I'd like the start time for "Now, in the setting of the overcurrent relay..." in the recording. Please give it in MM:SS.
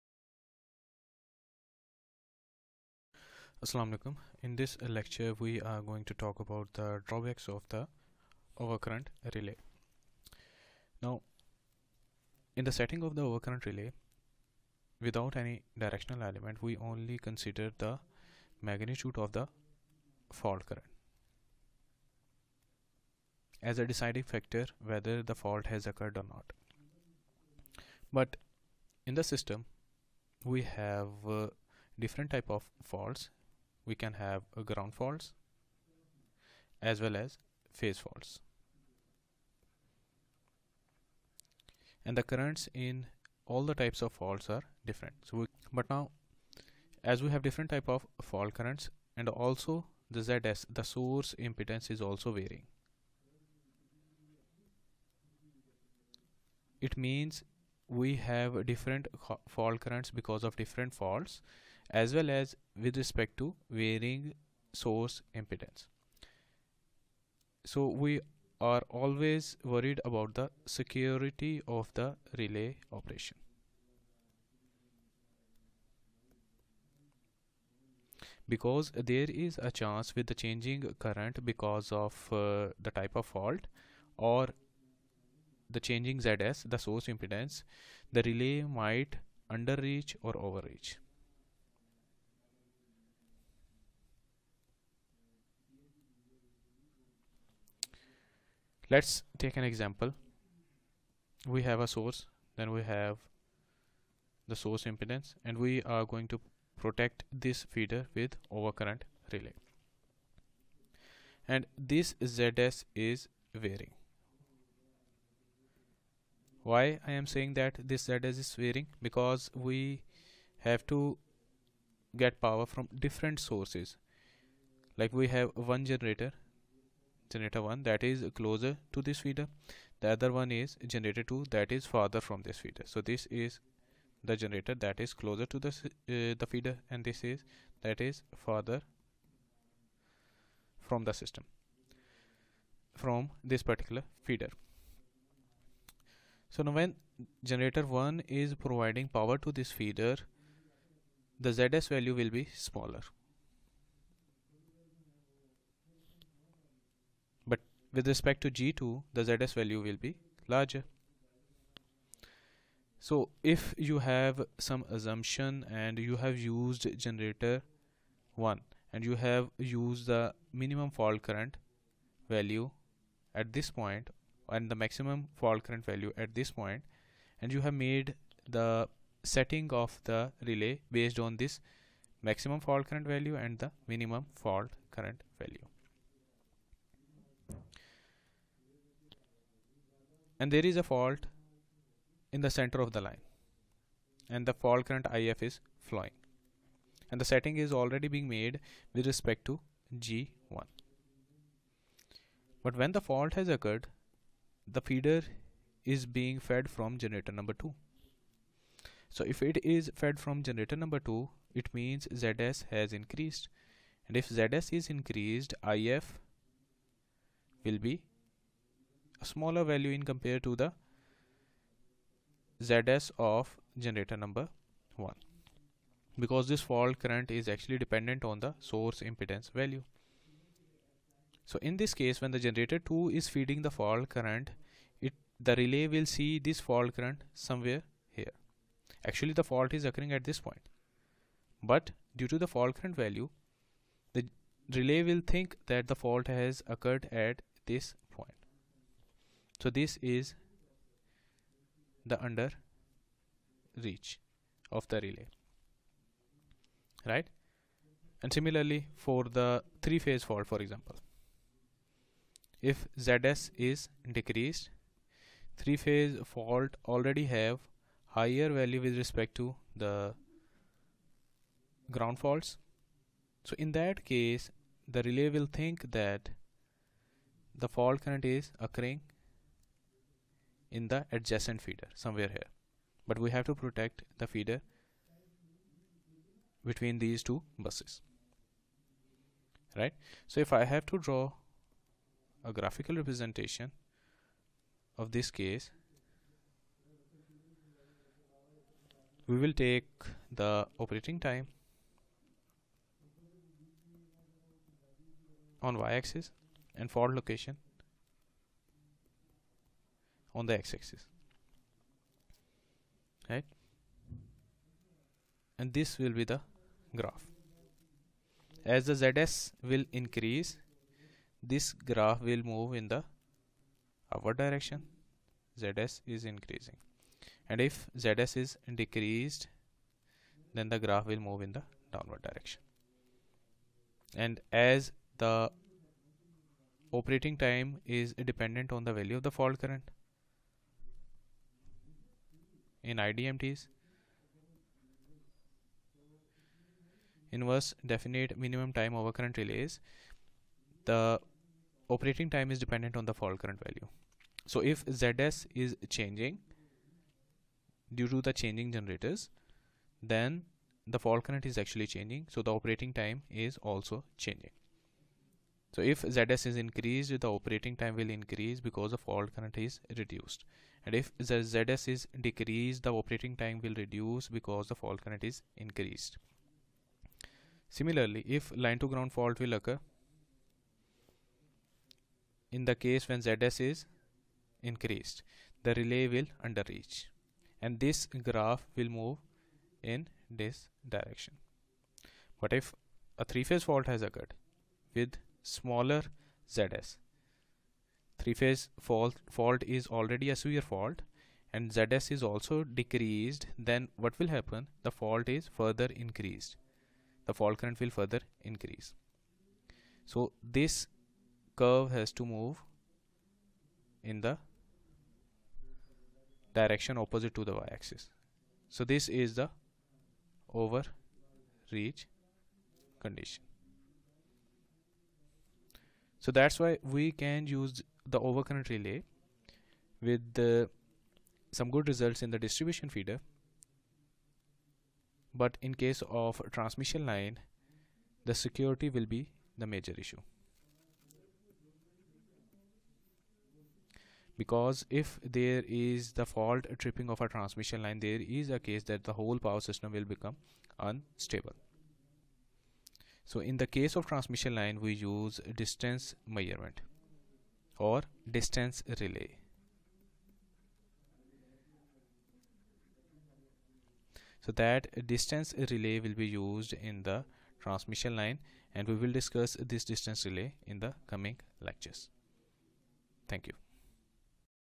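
00:11.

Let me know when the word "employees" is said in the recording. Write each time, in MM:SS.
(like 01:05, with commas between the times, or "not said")
not said.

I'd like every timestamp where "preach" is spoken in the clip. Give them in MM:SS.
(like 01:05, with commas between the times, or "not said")
not said.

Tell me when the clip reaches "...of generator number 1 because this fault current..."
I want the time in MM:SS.
03:43.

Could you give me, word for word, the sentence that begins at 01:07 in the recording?
So we are always worried about the security of the relay operation.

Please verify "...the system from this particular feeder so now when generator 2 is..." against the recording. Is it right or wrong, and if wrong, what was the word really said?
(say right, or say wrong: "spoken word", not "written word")
wrong: "1", not "2".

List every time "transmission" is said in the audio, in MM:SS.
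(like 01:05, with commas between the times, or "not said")
07:16, 07:27, 07:34, 07:47.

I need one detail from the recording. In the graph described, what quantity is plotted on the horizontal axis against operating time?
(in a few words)
location.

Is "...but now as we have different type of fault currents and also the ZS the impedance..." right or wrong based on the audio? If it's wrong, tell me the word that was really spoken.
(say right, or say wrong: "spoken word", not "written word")
wrong: "source", not "impedance".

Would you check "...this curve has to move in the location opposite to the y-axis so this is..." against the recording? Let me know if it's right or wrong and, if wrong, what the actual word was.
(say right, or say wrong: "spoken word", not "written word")
wrong: "direction", not "location".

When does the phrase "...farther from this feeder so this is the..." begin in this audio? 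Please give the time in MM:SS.
02:11.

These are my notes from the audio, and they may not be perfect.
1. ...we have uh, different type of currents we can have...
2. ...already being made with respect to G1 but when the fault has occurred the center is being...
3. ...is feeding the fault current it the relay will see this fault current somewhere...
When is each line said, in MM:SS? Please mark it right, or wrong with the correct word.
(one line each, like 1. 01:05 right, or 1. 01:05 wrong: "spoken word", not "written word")
1. 00:30 wrong: "faults", not "currents"
2. 03:17 wrong: "feeder", not "center"
3. 03:53 right.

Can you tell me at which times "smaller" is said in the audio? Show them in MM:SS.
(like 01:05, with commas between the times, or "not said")
02:32, 03:39, 06:35.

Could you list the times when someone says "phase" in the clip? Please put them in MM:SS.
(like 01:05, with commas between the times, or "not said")
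00:37, 04:20, 04:25, 06:33, 06:38.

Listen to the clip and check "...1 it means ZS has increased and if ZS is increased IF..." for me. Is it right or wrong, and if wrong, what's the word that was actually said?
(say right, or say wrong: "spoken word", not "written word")
wrong: "2", not "1".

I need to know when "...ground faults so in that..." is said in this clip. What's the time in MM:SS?
04:31.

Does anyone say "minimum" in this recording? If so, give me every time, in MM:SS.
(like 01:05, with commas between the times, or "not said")
02:50, 03:03, 05:48.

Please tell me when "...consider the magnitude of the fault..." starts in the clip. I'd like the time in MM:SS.
00:17.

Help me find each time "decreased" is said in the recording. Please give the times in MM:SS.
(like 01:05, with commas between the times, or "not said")
04:24, 05:28, 06:12, 06:42.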